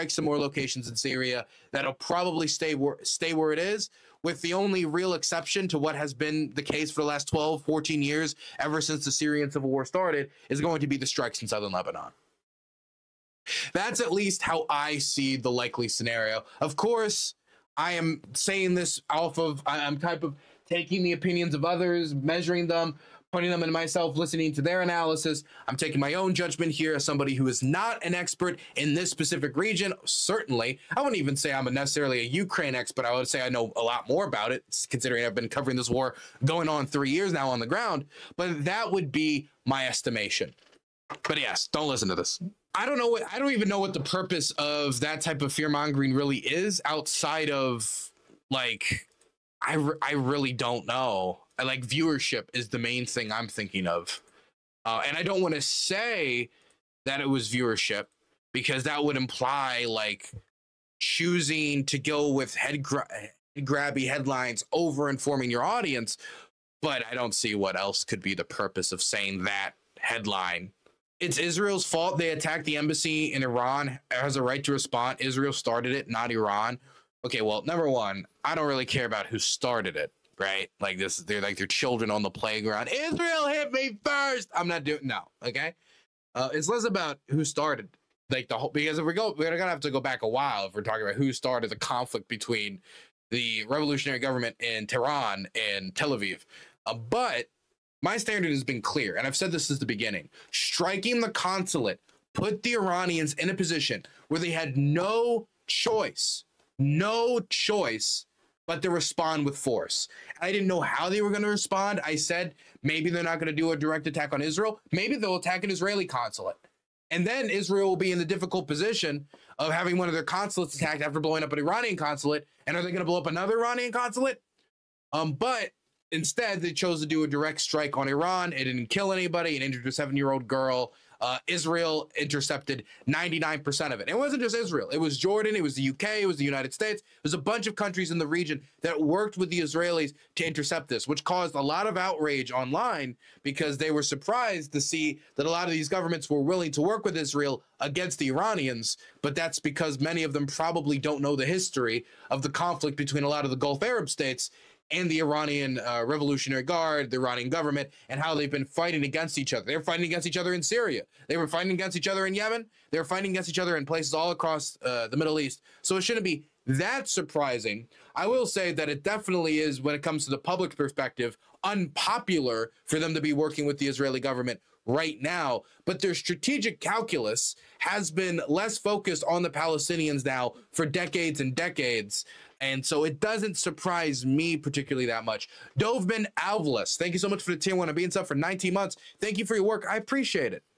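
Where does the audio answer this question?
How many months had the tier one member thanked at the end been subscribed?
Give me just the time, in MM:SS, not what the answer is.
03:08.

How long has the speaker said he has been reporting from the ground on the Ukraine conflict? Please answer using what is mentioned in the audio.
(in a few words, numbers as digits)
almost 3 years.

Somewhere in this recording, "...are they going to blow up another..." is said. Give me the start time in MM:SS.
02:02.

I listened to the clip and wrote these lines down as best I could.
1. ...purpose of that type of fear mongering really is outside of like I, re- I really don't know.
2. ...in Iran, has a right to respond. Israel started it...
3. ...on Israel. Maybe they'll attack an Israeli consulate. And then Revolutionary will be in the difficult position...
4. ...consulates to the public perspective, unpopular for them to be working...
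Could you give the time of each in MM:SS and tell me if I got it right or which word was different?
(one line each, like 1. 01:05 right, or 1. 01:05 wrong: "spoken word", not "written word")
1. 00:43 right
2. 01:13 right
3. 01:54 wrong: "Israel", not "Revolutionary"
4. 02:50 wrong: "comes", not "consulates".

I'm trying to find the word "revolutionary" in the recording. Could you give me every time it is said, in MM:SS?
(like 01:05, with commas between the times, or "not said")
01:33, 02:36.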